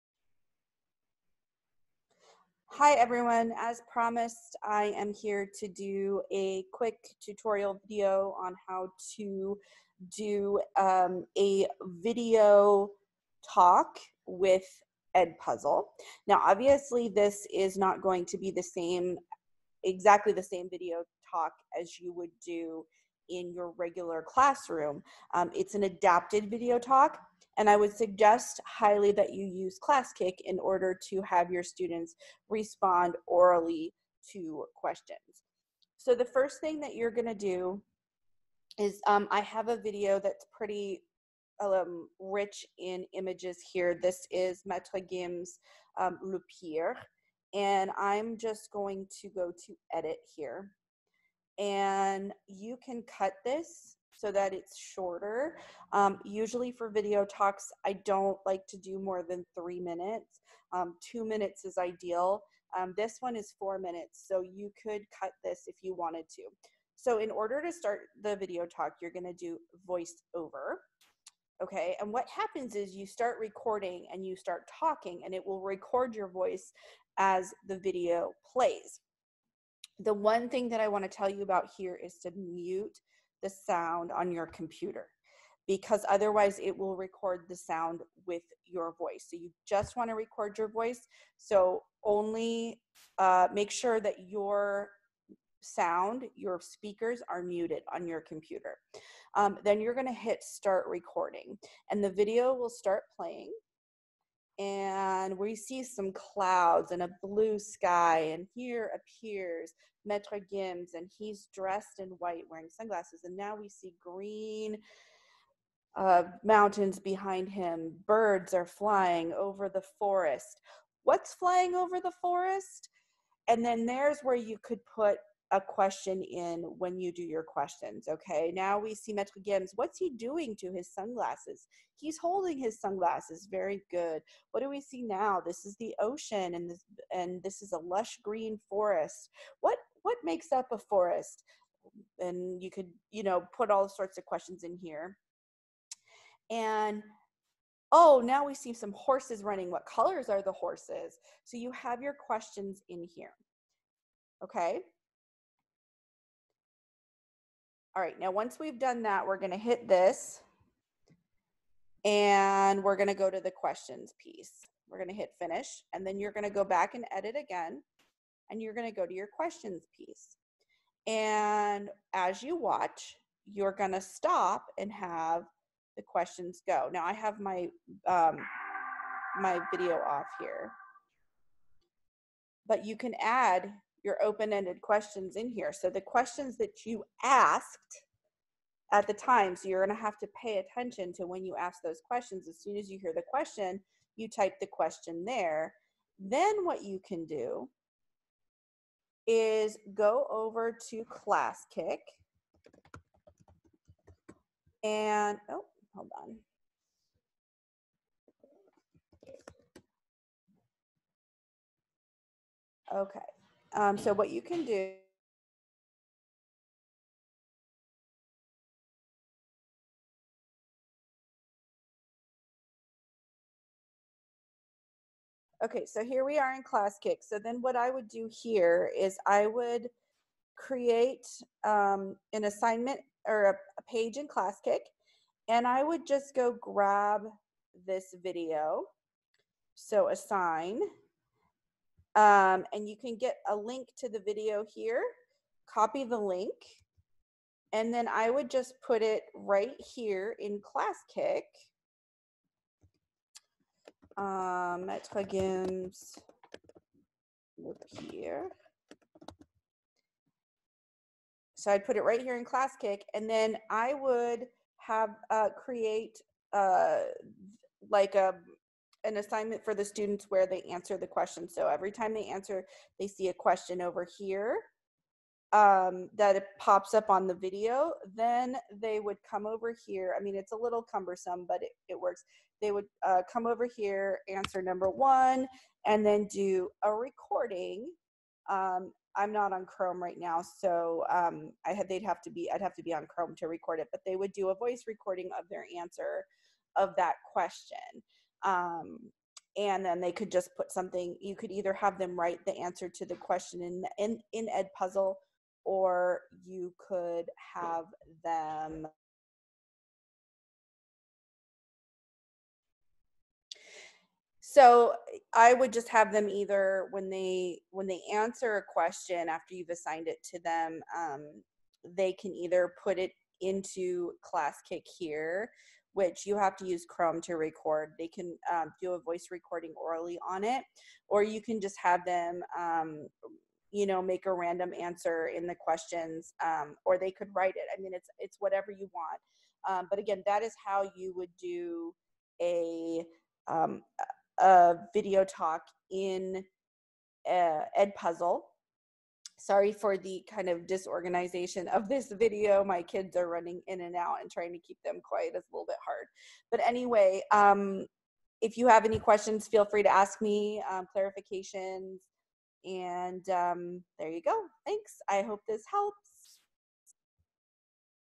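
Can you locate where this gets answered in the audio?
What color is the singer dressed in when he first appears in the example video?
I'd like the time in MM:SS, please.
01:52.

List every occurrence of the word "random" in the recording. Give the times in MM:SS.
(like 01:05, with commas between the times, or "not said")
05:34.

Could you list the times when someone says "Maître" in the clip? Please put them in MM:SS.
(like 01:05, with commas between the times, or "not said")
00:44, 01:50, 02:09, 04:14.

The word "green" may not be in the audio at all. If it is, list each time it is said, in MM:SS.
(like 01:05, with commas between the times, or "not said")
01:54, 02:18.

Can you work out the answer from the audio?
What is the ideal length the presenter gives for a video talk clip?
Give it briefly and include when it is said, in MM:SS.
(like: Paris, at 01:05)
2 minutes, at 01:01.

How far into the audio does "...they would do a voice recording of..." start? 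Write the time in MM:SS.
04:54.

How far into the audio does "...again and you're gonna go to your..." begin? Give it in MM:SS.
02:47.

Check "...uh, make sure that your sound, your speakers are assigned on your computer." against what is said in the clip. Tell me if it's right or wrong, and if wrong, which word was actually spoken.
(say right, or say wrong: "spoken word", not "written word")
wrong: "muted", not "assigned".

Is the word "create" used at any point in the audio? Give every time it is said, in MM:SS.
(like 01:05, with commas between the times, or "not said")
03:50, 04:25.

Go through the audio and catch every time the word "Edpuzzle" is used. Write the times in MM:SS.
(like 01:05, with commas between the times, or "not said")
00:15, 05:47.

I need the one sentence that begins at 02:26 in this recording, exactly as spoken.
And oh, now we see some horses running.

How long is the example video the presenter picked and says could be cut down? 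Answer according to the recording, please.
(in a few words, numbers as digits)
4 minutes.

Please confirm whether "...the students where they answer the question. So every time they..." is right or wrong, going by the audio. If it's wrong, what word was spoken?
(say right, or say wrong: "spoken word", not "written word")
right.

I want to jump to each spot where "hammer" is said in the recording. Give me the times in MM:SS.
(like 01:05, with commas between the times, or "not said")
not said.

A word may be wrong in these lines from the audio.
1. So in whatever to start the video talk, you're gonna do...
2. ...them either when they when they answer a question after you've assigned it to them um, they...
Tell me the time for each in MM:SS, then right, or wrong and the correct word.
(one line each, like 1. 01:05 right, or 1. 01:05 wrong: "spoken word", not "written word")
1. 01:06 wrong: "order", not "whatever"
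2. 05:16 right.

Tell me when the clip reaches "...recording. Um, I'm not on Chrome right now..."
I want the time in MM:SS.
04:46.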